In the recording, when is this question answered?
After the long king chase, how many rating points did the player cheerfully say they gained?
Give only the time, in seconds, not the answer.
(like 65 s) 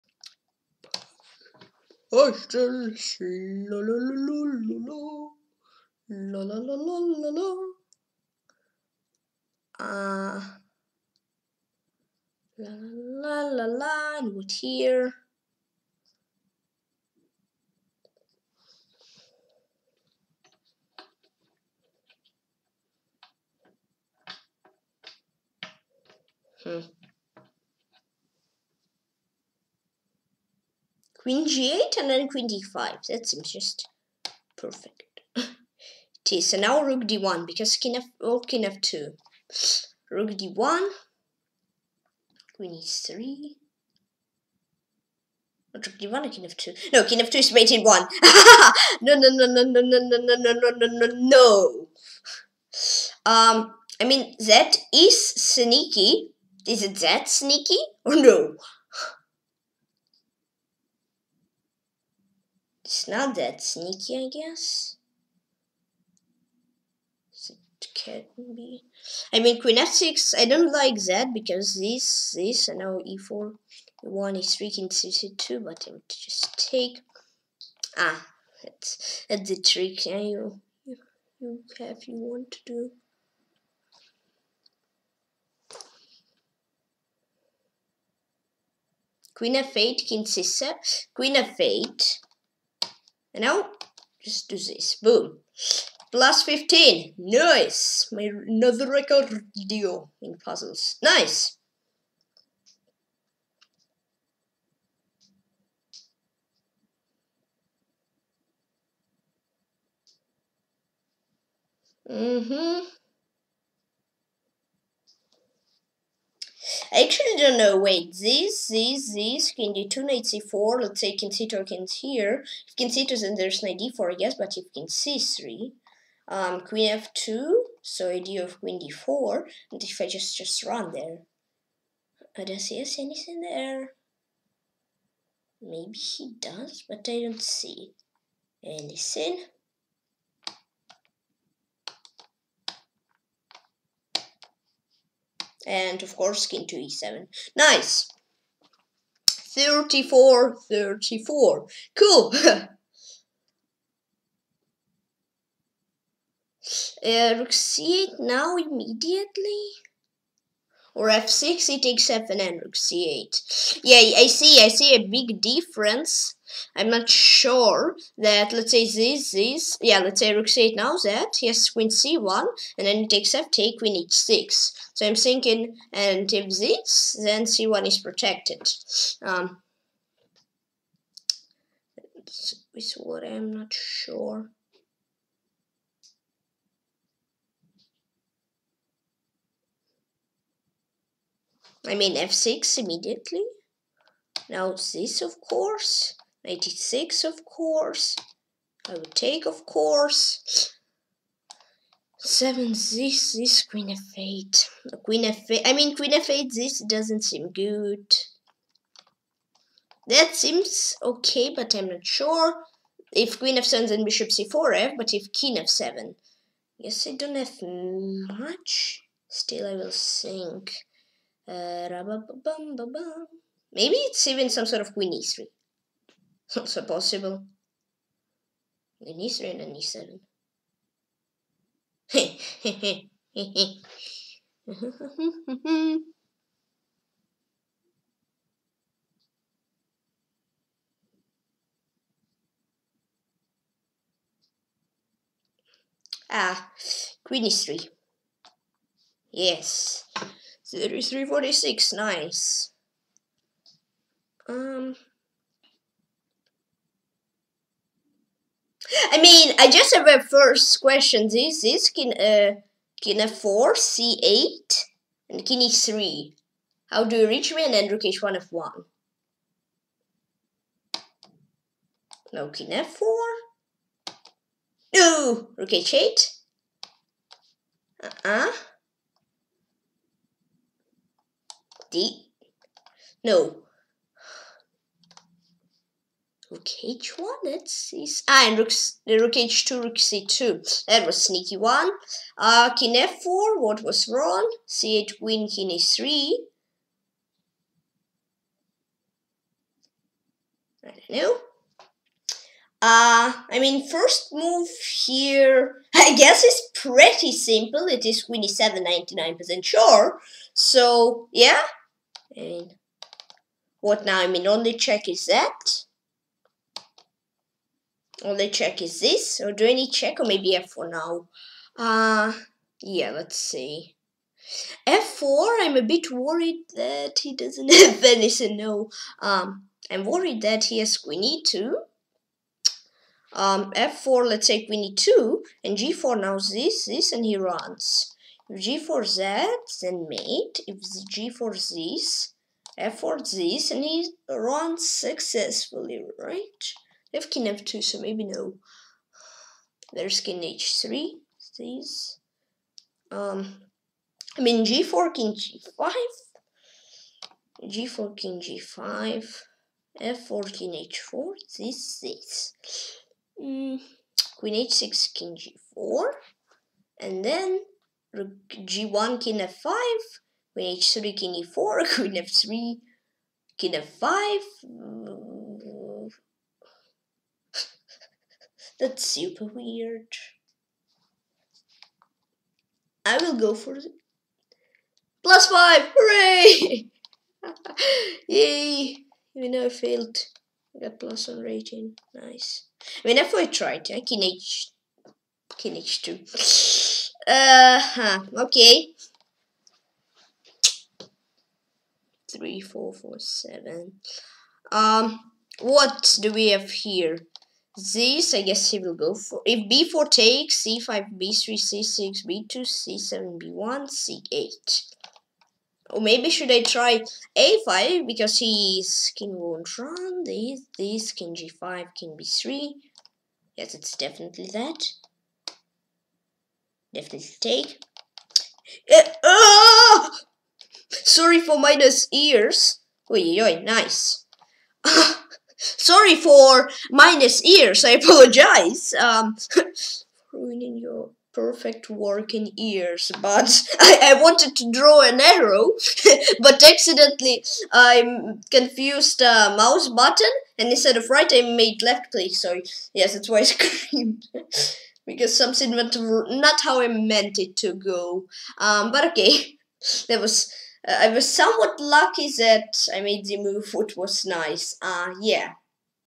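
385 s.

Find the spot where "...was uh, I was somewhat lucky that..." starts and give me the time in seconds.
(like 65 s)
460 s.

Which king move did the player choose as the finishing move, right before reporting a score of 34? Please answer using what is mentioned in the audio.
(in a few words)
King to e7.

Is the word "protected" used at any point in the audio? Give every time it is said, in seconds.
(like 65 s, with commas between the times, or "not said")
177 s.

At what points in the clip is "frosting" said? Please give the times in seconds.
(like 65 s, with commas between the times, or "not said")
not said.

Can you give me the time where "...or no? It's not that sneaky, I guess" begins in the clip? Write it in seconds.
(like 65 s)
58 s.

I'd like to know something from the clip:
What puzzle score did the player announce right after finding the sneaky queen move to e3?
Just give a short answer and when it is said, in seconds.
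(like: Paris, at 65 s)
346, at 250 s.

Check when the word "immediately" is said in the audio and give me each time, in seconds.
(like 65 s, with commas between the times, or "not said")
158 s, 192 s.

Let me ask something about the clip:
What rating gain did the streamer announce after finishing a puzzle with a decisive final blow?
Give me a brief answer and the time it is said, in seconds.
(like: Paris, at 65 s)
+15, at 96 s.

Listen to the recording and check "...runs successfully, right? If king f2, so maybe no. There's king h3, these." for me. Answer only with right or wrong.
right.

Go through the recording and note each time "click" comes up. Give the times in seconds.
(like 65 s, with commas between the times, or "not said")
452 s.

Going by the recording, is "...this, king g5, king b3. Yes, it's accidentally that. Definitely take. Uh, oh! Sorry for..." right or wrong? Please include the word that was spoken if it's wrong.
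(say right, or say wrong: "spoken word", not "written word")
wrong: "definitely", not "accidentally".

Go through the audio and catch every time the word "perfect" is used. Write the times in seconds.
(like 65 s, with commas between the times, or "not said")
34 s, 441 s.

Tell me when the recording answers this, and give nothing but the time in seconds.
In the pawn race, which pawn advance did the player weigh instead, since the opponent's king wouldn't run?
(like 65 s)
417 s.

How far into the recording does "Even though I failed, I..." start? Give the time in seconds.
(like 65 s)
389 s.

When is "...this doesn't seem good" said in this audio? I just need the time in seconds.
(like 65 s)
206 s.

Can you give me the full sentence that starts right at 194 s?
Now this of course, six, of course, I would take of course.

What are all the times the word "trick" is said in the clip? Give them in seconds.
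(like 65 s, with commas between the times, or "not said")
79 s.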